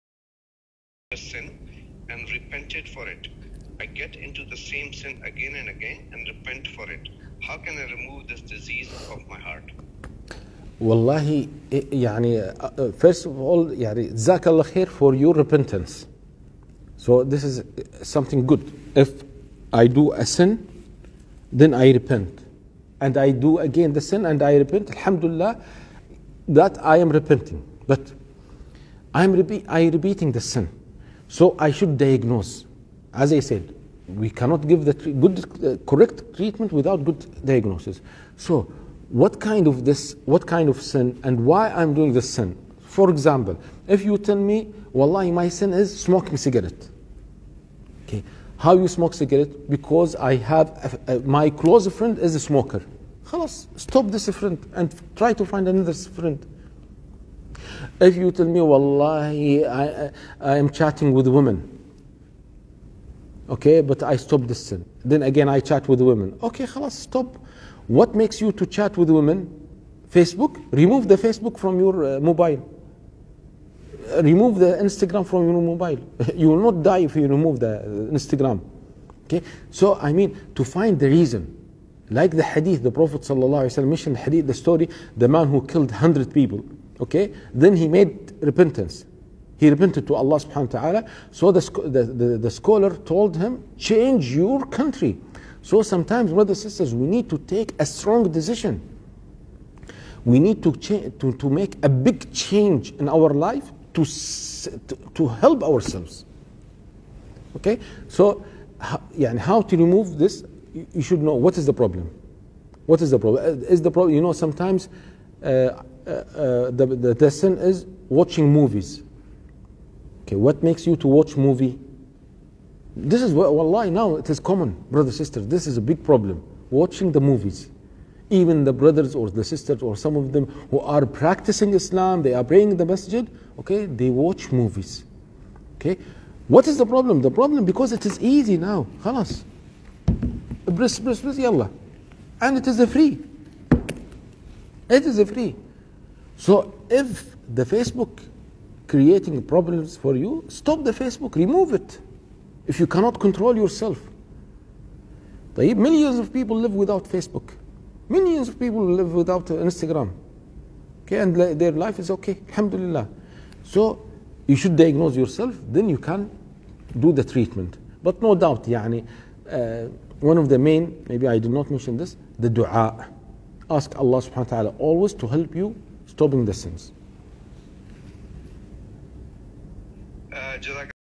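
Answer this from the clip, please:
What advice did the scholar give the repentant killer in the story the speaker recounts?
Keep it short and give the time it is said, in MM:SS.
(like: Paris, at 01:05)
change your country, at 01:33.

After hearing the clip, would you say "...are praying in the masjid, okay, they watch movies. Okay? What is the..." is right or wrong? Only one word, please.
right.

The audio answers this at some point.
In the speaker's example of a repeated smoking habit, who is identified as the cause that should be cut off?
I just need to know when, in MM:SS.
00:51.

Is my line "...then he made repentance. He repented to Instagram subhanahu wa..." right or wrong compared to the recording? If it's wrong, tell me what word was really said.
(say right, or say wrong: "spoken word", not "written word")
wrong: "Allah", not "Instagram".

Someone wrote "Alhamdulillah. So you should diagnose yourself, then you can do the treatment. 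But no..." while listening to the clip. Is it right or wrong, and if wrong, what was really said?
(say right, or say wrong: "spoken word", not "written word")
right.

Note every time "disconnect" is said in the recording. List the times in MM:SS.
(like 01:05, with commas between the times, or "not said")
not said.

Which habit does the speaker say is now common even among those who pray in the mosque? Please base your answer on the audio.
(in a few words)
watching movies.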